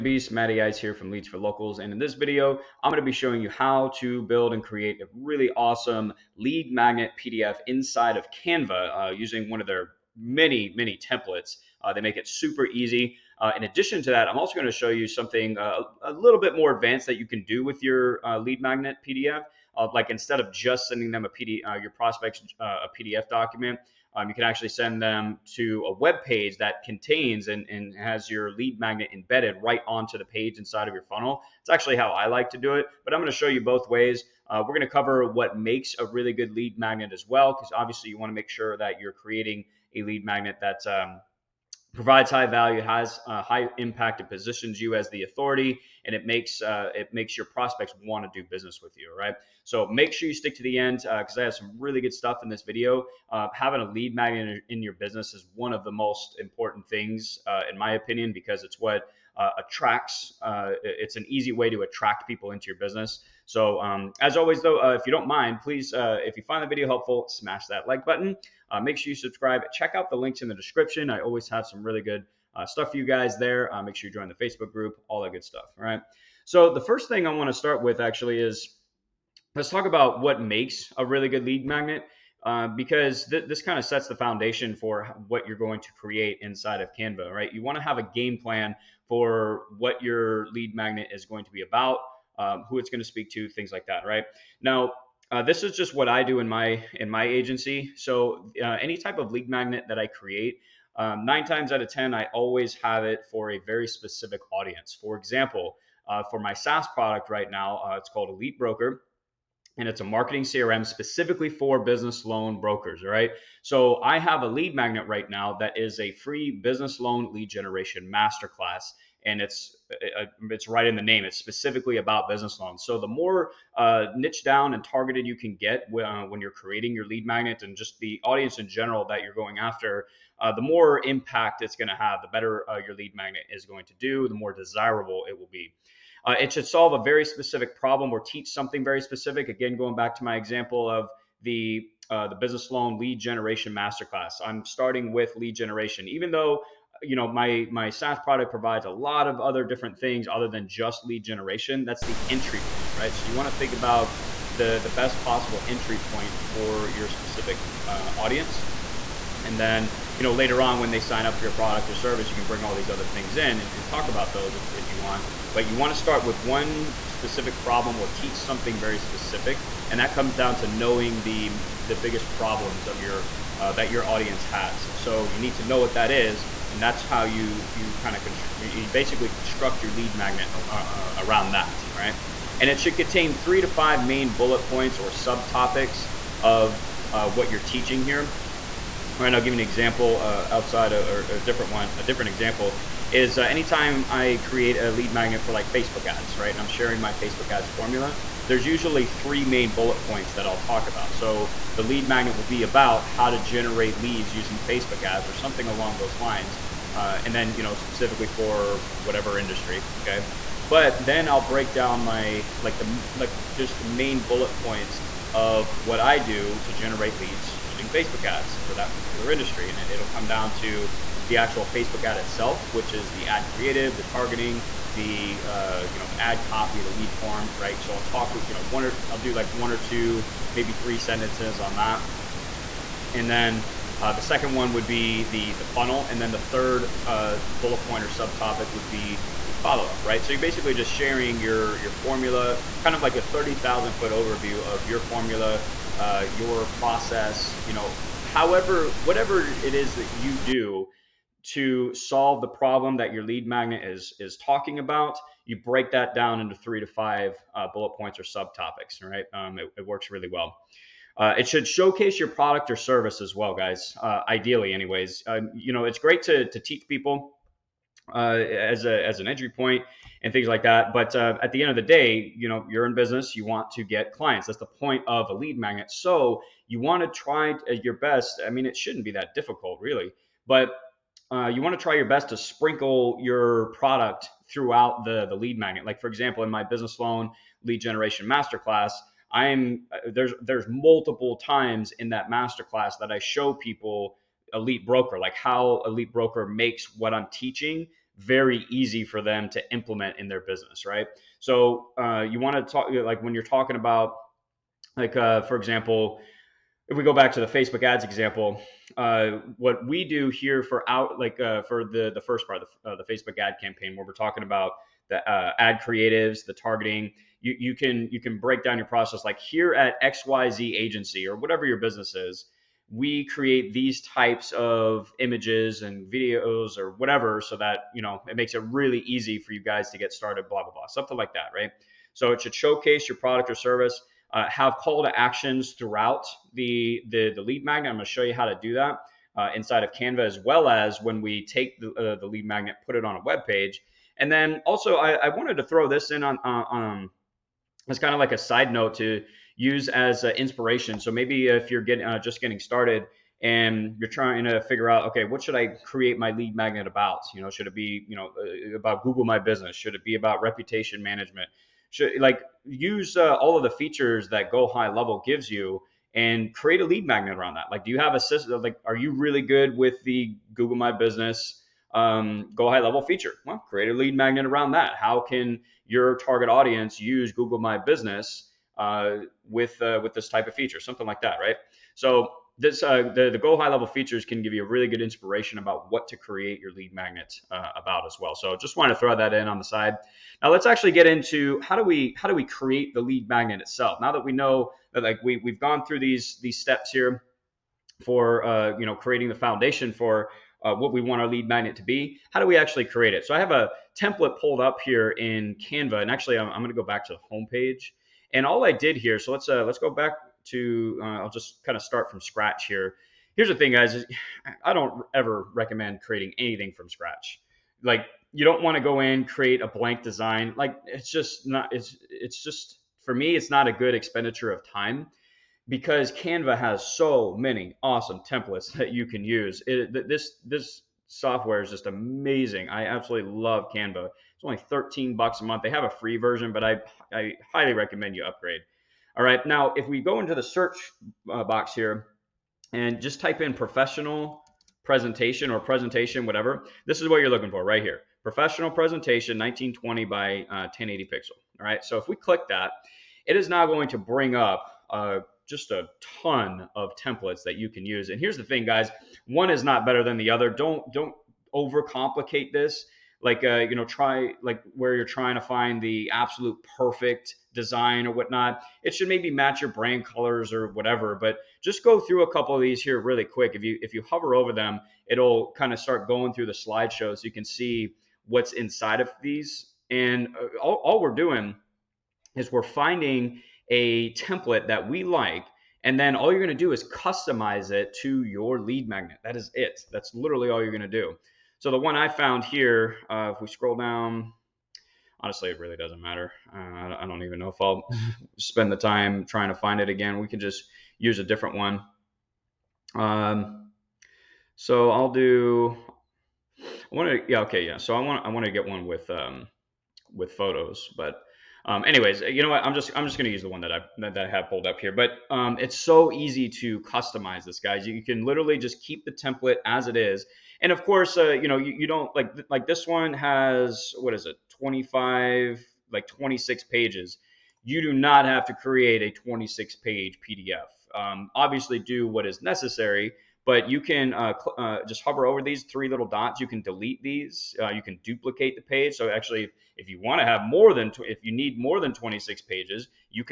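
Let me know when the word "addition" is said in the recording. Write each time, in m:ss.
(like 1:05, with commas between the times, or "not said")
0:13.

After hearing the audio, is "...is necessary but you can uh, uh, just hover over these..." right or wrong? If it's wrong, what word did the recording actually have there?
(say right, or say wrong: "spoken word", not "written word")
right.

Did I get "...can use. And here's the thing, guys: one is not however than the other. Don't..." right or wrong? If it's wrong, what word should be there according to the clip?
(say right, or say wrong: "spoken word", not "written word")
wrong: "better", not "however".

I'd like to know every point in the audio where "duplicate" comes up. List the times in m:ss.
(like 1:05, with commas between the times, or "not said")
8:58.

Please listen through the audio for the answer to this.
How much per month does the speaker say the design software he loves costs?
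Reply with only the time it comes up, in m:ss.
7:14.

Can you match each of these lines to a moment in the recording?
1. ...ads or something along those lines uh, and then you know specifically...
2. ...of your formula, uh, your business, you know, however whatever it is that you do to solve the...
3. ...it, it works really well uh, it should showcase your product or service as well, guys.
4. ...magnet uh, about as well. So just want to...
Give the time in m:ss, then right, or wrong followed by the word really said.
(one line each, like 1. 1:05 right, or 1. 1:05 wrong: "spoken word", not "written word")
1. 3:25 right
2. 4:04 wrong: "process", not "business"
3. 4:19 right
4. 6:26 right.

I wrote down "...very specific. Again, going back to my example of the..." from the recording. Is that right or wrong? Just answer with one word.
right.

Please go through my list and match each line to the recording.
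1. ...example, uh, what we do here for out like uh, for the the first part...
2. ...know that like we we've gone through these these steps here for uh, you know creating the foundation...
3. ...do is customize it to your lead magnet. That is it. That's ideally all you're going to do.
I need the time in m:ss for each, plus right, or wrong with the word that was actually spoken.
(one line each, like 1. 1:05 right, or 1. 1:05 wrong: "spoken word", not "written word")
1. 5:08 right
2. 6:34 right
3. 8:06 wrong: "literally", not "ideally".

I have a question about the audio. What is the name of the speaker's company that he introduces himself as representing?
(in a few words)
Leads for Locals.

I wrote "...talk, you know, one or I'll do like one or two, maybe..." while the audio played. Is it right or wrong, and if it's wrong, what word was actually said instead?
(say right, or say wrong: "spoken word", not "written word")
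right.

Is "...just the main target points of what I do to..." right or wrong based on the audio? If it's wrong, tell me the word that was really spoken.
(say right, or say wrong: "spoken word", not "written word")
wrong: "bullet", not "target".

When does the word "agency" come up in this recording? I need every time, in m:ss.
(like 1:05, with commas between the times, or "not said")
1:37, 5:20.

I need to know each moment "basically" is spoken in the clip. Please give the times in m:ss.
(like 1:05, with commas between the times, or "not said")
2:58, 4:00.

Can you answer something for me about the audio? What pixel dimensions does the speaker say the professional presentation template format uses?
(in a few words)
1920 by 1080.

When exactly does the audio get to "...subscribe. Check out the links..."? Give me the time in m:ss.
1:09.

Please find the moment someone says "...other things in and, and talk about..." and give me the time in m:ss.
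2:42.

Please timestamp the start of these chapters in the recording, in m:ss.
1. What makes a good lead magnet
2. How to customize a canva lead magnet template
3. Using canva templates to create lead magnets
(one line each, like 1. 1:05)
1. 1:17
2. 8:37
3. 6:53.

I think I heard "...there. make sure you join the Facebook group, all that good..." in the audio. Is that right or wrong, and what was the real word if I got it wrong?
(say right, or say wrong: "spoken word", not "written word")
right.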